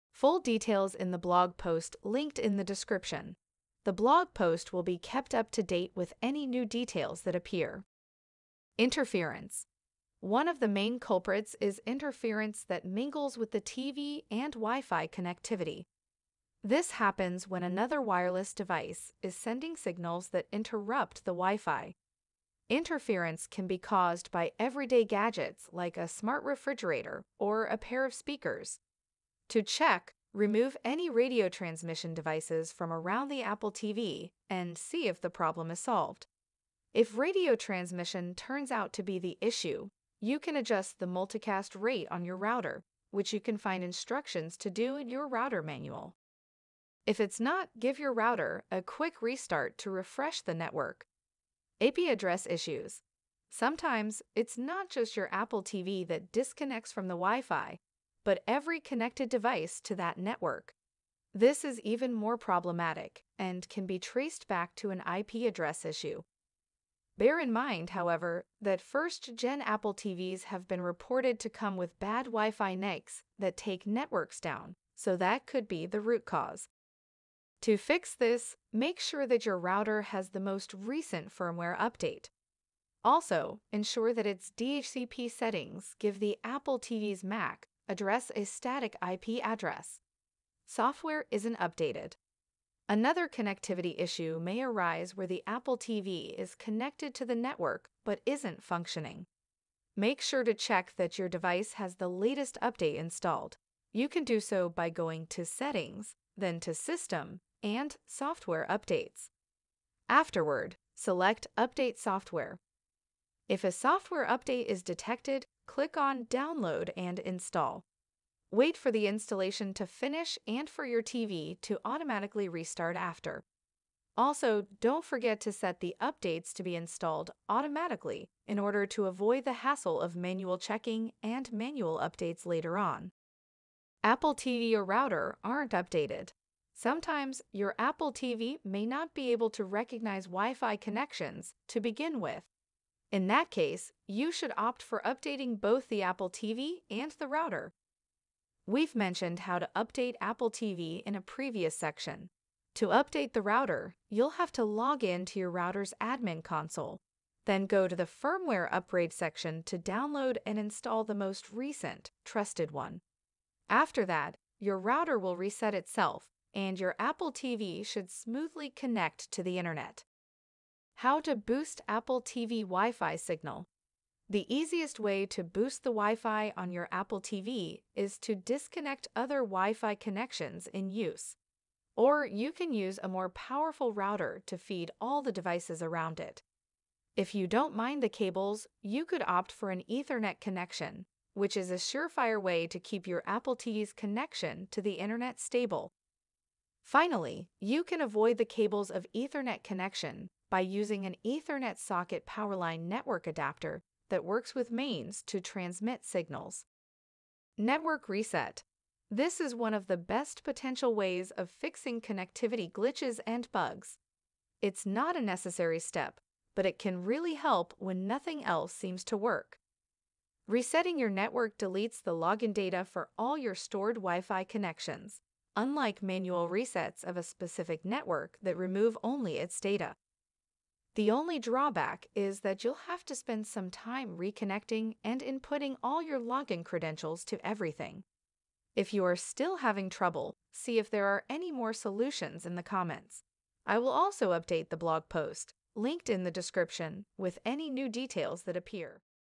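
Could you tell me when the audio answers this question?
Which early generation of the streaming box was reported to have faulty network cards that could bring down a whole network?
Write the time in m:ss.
1:08.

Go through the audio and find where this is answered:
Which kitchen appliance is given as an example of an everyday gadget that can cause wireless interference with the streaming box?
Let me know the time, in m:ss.
0:26.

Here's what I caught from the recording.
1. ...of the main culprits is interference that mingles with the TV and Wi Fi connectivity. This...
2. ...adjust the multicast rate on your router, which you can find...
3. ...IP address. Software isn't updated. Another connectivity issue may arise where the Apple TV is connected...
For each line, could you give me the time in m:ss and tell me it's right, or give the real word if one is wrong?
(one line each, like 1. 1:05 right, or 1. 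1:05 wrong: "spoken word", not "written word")
1. 0:10 right
2. 0:40 right
3. 1:29 right.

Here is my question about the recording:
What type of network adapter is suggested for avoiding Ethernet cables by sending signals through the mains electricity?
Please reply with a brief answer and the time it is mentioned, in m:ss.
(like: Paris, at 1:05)
Powerline network adapter, at 3:22.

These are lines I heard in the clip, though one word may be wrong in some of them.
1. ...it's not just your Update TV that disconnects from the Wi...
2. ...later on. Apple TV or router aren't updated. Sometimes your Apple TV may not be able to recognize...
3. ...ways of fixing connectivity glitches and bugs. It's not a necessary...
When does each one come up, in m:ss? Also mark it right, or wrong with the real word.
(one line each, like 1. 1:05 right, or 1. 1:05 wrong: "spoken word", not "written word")
1. 0:54 wrong: "Apple", not "Update"
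2. 2:12 right
3. 3:30 right.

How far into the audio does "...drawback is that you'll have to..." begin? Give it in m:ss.
3:51.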